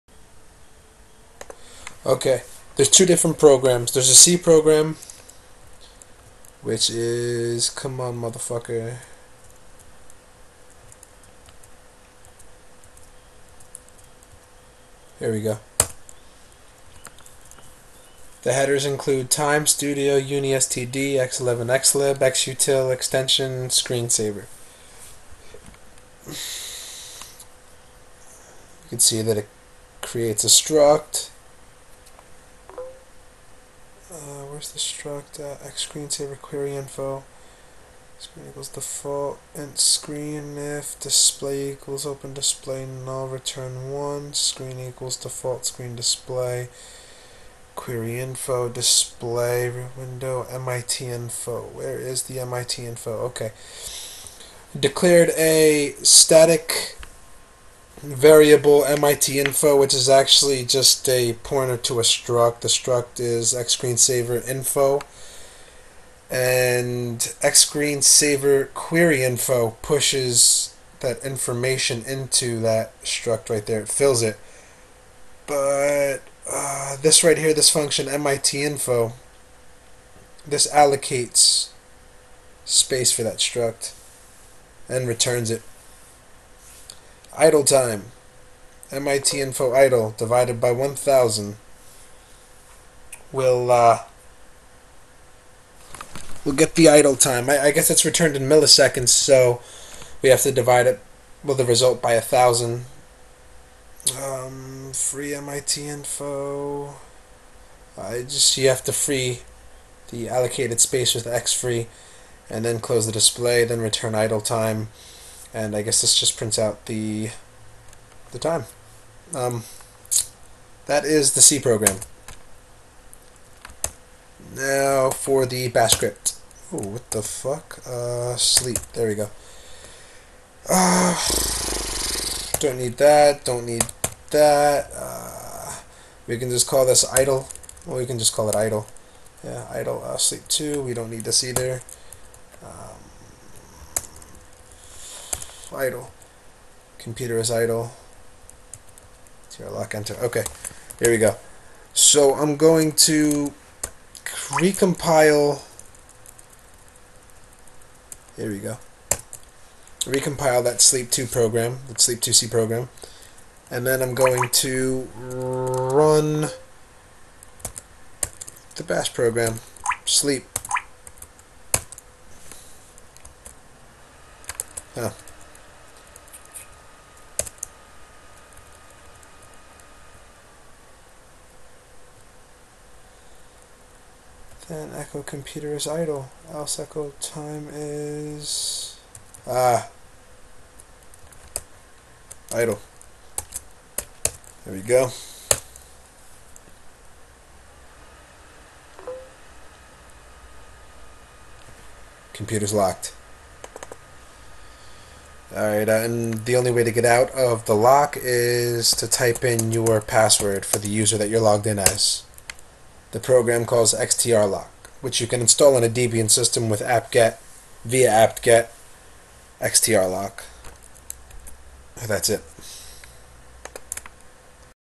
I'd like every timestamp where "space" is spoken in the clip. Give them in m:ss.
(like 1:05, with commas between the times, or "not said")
1:22, 1:50.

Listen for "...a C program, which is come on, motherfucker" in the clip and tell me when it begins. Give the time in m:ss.
0:04.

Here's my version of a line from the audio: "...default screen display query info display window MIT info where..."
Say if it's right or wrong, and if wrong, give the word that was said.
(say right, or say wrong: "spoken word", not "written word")
right.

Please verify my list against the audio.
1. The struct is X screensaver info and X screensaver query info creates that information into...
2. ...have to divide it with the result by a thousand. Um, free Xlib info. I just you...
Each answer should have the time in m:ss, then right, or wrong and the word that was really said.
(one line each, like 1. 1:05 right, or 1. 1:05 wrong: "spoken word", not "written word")
1. 1:02 wrong: "pushes", not "creates"
2. 1:40 wrong: "MIT", not "Xlib".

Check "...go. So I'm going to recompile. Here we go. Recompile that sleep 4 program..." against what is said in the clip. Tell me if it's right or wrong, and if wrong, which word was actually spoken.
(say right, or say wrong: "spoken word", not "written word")
wrong: "2", not "4".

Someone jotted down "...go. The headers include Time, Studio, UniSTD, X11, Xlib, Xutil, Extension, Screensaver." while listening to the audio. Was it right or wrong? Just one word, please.
right.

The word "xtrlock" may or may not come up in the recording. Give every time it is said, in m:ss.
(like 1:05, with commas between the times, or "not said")
3:33, 3:39.